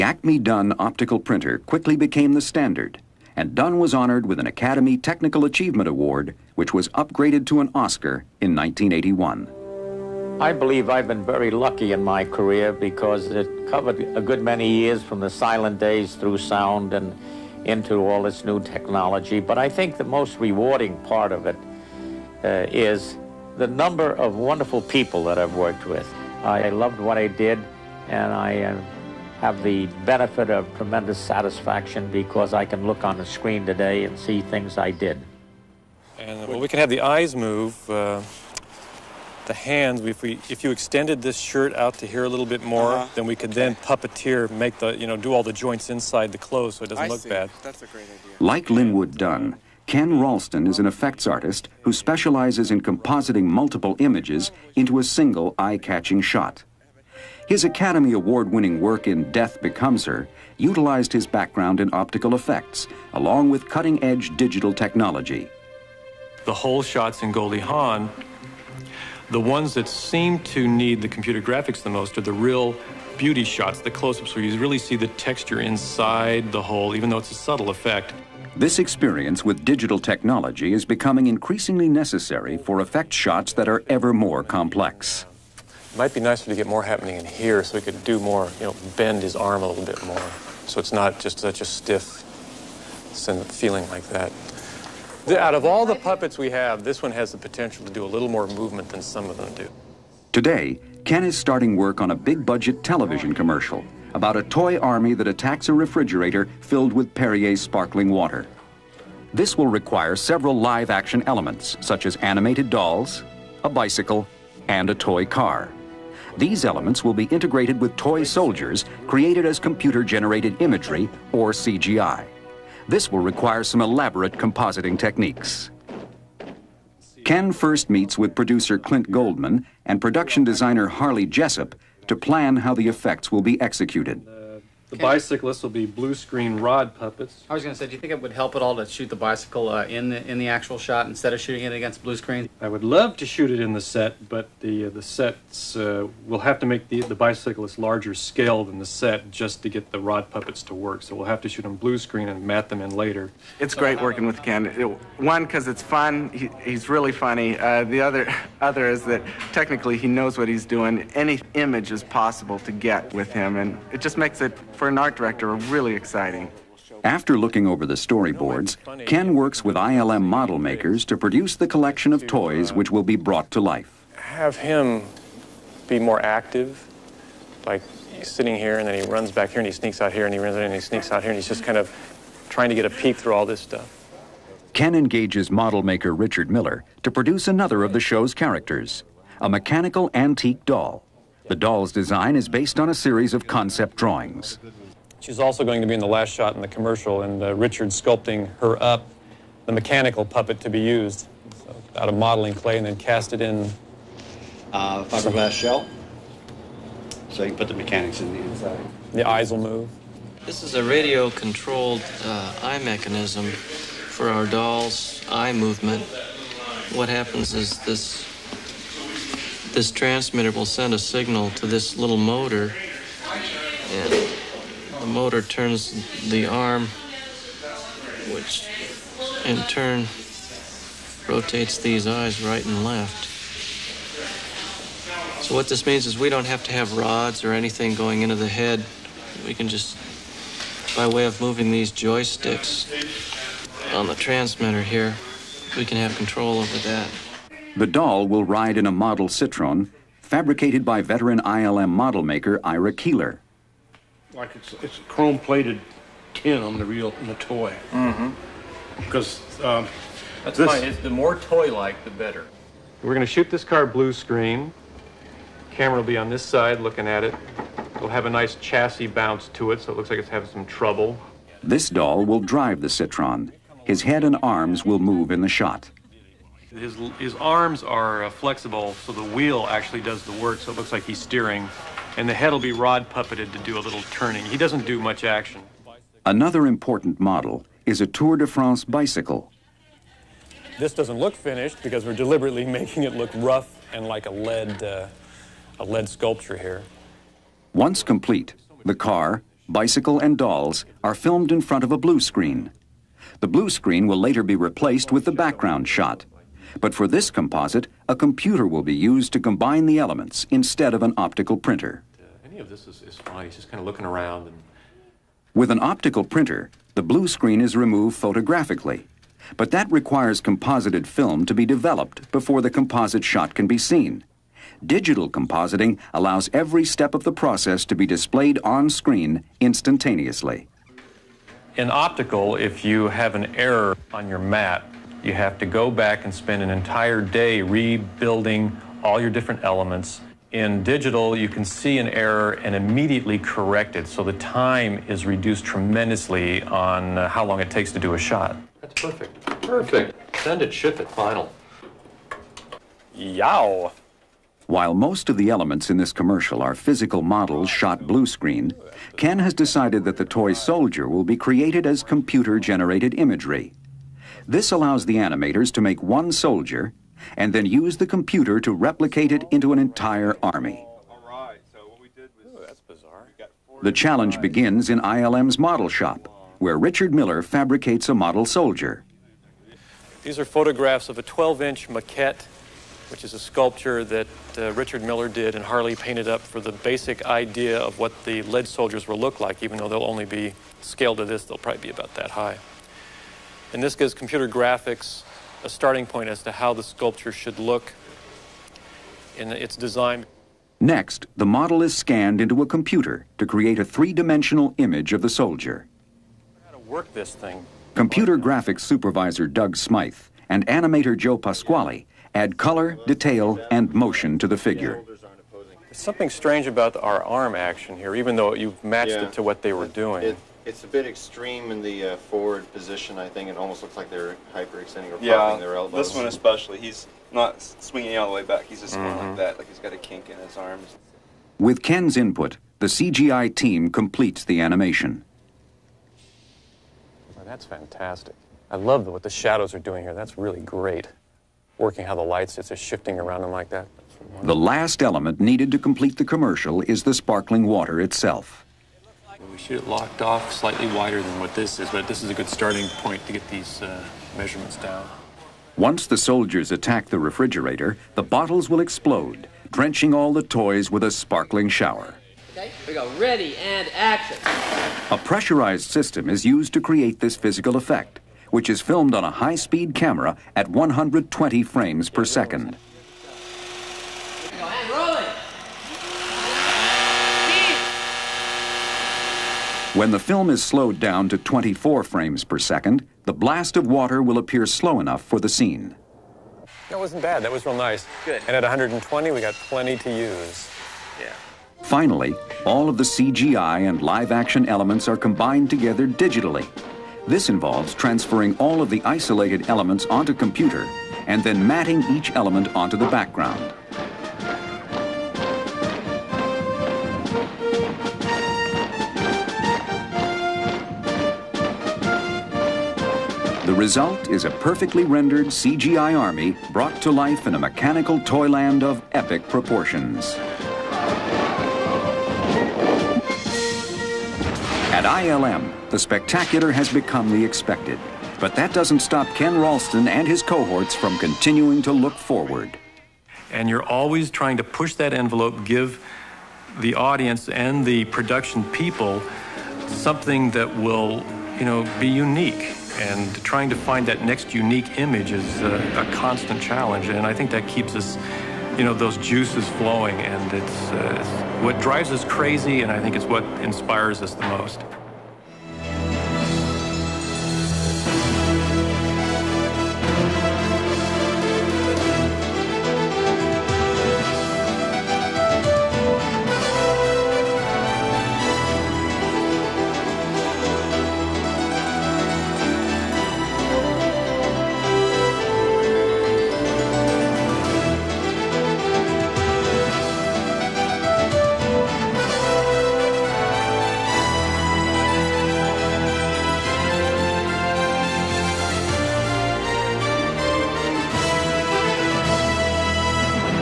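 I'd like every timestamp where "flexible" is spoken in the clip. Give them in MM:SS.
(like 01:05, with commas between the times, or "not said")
04:38.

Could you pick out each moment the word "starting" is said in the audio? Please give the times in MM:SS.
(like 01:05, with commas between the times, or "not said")
01:41, 06:35, 07:32.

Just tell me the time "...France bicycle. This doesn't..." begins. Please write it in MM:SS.
04:48.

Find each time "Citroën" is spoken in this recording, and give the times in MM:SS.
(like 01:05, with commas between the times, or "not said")
04:09, 04:32.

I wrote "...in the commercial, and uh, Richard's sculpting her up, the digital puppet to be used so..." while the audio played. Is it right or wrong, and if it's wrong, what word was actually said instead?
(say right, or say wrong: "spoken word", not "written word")
wrong: "mechanical", not "digital".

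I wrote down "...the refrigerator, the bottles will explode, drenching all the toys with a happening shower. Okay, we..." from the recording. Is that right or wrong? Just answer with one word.
wrong.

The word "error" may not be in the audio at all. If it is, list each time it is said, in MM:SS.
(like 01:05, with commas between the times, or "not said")
05:33, 05:42.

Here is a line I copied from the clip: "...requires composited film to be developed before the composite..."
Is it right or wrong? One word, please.
right.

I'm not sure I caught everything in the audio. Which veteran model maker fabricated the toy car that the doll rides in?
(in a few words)
Ira Keeler.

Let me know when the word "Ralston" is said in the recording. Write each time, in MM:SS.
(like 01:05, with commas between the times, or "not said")
00:50, 08:49.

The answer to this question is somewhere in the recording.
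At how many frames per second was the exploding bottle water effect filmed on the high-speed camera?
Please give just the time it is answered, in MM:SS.
07:50.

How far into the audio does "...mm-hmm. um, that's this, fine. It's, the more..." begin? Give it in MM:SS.
04:19.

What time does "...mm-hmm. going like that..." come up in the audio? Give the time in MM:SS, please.
07:08.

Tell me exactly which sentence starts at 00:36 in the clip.
And well, we can have the eyes move, uh, the hands.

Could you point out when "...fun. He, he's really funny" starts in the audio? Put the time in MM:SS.
02:35.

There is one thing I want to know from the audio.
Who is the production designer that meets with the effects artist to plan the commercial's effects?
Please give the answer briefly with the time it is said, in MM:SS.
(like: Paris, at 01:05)
Harley Jessup, at 02:10.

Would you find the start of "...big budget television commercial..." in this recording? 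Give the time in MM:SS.
01:42.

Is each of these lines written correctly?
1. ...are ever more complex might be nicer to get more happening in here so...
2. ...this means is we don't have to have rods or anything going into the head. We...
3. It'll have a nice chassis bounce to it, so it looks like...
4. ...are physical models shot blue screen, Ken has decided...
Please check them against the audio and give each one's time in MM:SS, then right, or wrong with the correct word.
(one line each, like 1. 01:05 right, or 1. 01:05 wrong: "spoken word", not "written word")
1. 01:23 right
2. 03:55 right
3. 04:27 right
4. 05:56 right.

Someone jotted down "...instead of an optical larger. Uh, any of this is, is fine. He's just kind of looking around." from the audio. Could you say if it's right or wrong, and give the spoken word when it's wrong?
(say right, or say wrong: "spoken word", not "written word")
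wrong: "printer", not "larger".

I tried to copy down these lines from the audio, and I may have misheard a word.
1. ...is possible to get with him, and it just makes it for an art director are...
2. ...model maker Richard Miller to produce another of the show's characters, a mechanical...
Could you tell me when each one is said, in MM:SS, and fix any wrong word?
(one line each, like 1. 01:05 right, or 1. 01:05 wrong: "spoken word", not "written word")
1. 02:41 right
2. 03:05 right.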